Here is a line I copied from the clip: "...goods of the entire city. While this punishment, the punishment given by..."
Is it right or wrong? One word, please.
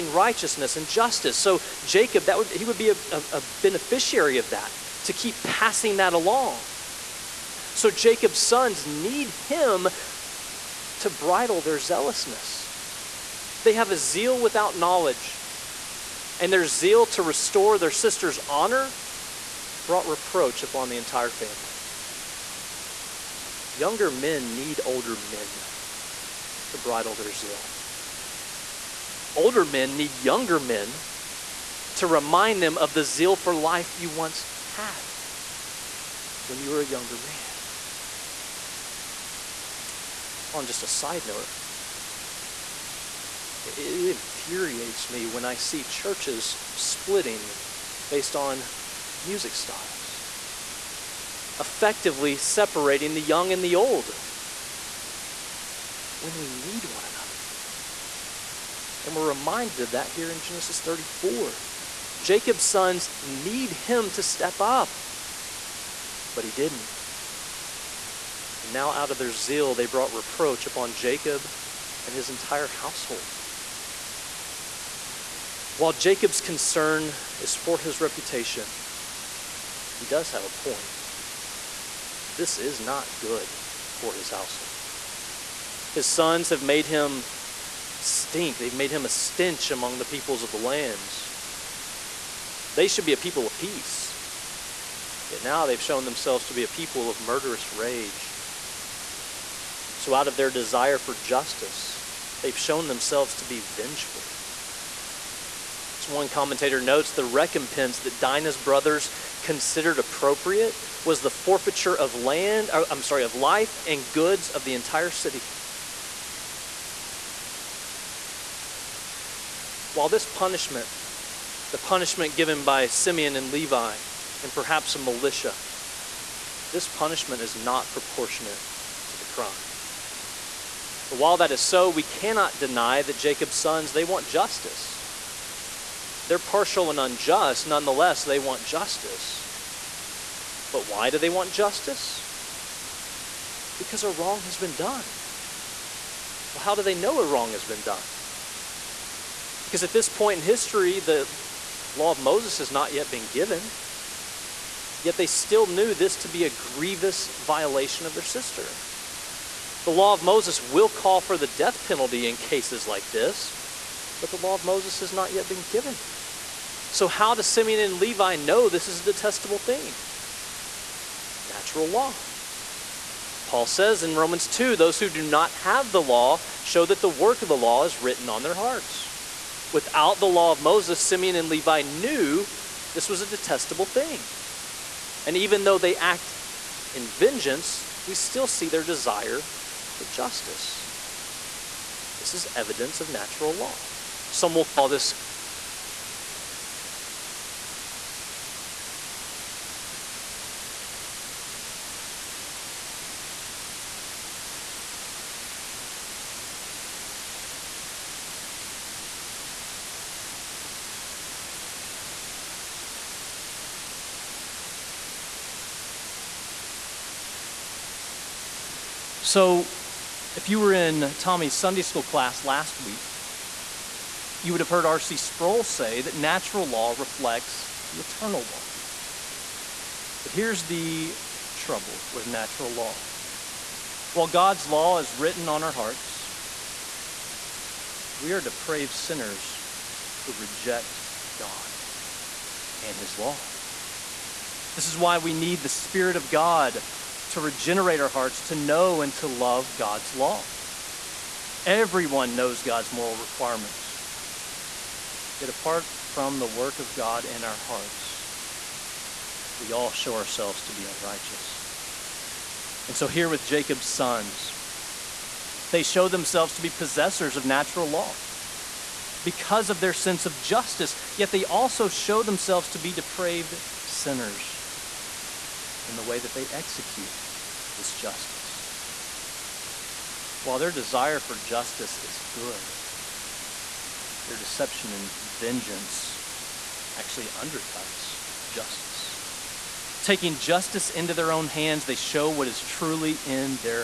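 right.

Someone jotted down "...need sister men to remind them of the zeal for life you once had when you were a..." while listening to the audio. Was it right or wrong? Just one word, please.
wrong.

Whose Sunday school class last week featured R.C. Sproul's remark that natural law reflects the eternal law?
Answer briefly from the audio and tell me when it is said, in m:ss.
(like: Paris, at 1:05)
Tommy, at 3:41.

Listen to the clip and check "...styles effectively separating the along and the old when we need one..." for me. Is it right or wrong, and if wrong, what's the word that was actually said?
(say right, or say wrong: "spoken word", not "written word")
wrong: "young", not "along".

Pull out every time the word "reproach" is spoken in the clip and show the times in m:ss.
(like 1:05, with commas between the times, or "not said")
0:20, 1:10.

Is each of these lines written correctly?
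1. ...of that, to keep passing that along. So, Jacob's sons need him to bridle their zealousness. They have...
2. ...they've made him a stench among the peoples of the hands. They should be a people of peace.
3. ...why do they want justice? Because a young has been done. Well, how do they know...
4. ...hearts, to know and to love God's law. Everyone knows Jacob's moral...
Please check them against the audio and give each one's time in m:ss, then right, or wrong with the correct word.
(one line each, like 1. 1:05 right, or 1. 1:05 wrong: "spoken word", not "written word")
1. 0:04 right
2. 1:28 wrong: "lands", not "hands"
3. 2:20 wrong: "wrong", not "young"
4. 4:08 wrong: "God", not "Jacob".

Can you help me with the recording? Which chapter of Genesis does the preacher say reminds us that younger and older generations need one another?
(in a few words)
34.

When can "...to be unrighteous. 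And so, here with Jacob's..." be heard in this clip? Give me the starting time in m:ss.
4:20.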